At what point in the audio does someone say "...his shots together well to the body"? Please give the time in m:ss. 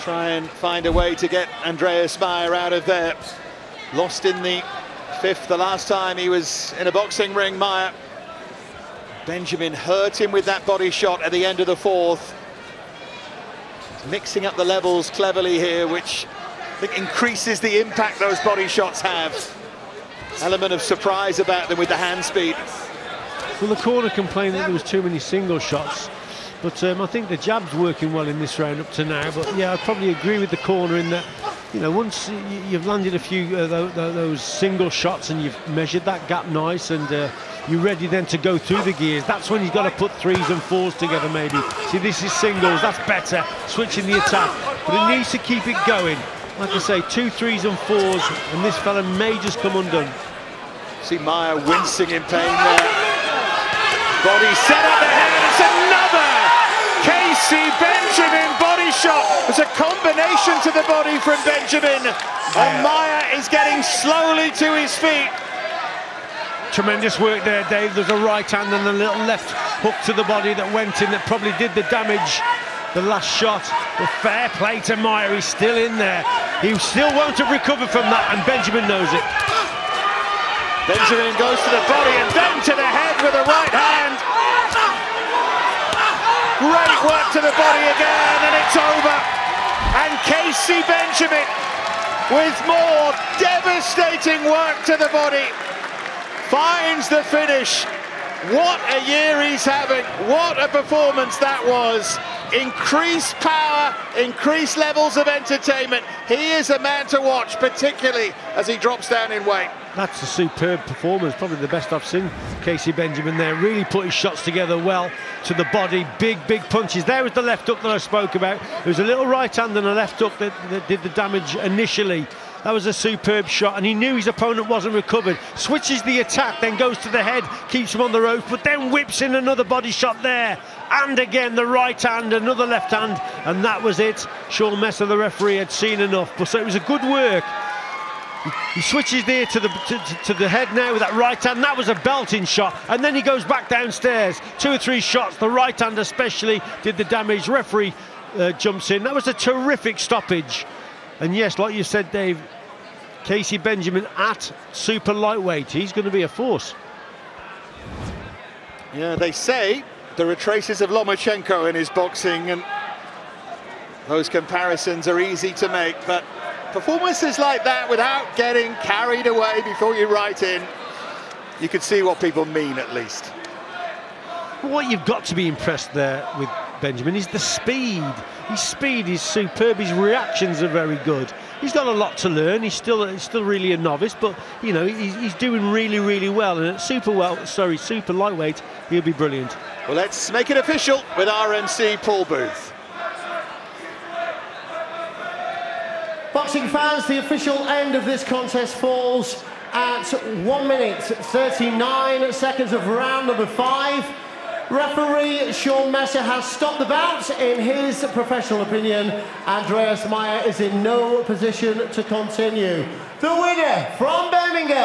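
1:54.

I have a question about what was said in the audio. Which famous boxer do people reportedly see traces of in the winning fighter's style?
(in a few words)
Lomachenko.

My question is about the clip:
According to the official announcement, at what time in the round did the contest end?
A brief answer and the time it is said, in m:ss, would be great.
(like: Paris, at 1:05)
1 minute 39 seconds, at 3:20.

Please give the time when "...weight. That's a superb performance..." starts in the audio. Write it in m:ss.
1:49.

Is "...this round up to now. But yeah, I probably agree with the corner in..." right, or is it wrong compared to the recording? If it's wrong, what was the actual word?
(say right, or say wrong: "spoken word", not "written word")
right.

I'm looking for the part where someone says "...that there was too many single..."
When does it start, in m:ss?
0:24.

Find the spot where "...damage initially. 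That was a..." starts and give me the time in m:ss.
2:01.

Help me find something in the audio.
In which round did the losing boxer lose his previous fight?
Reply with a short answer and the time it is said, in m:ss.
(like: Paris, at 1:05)
Fifth, at 0:05.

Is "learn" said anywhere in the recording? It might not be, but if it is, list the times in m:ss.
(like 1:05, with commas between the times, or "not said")
3:02.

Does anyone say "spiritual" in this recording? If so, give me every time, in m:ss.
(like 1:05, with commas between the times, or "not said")
not said.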